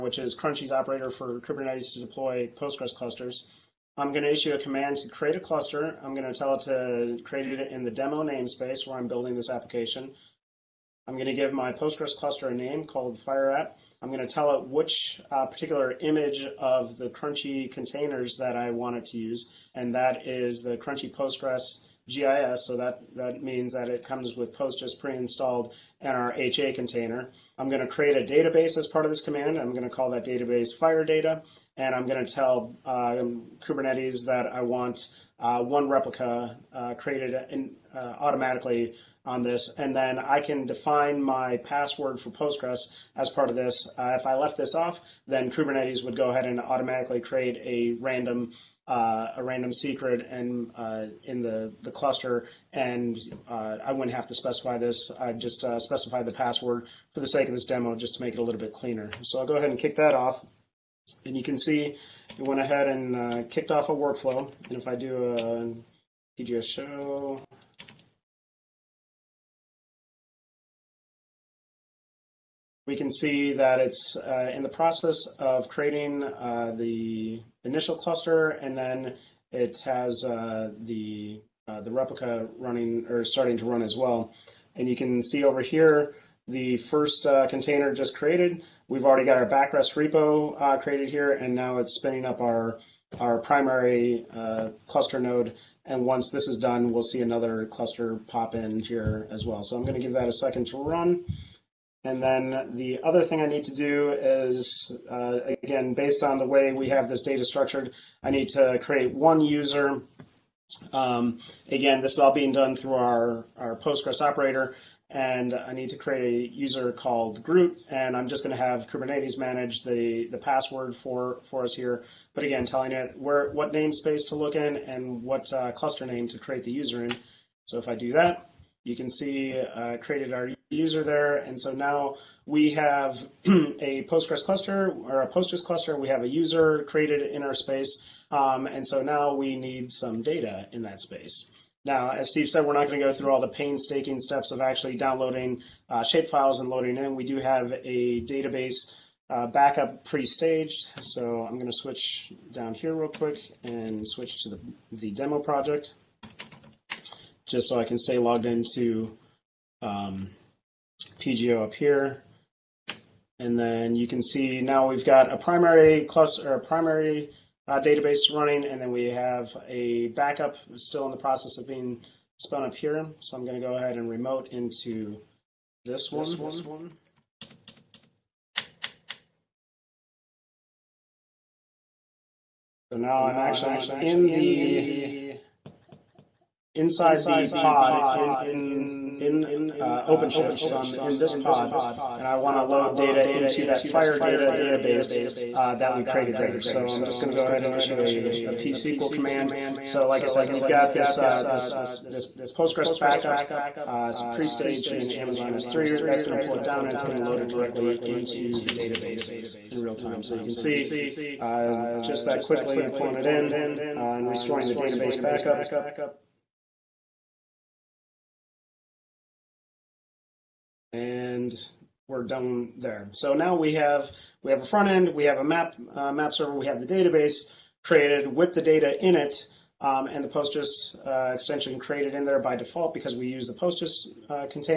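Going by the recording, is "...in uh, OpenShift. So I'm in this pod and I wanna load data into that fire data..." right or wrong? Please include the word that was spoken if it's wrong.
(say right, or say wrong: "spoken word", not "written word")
right.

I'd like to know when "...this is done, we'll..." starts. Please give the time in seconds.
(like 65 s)
96 s.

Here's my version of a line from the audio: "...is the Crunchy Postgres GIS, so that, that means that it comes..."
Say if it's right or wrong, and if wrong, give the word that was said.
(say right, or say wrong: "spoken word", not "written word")
right.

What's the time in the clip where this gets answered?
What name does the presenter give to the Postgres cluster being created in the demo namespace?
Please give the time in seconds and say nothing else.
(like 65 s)
13 s.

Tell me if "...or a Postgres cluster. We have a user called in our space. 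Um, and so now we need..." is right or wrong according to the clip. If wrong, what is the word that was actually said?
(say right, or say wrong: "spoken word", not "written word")
wrong: "created", not "called".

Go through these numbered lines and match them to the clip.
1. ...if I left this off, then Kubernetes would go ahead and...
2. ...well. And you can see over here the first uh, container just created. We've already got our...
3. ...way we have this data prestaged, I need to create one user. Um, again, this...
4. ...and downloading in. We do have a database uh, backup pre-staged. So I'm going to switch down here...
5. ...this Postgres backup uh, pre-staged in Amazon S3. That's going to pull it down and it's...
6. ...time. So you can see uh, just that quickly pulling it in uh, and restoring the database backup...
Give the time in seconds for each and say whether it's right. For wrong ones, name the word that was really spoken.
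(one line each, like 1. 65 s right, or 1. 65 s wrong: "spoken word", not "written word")
1. 44 s right
2. 83 s right
3. 106 s wrong: "structured", not "prestaged"
4. 146 s wrong: "loading", not "downloading"
5. 202 s right
6. 209 s right.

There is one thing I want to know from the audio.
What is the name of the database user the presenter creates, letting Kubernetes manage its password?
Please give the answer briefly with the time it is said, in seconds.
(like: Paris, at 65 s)
Groot, at 117 s.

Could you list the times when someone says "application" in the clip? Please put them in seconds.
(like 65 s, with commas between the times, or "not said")
9 s.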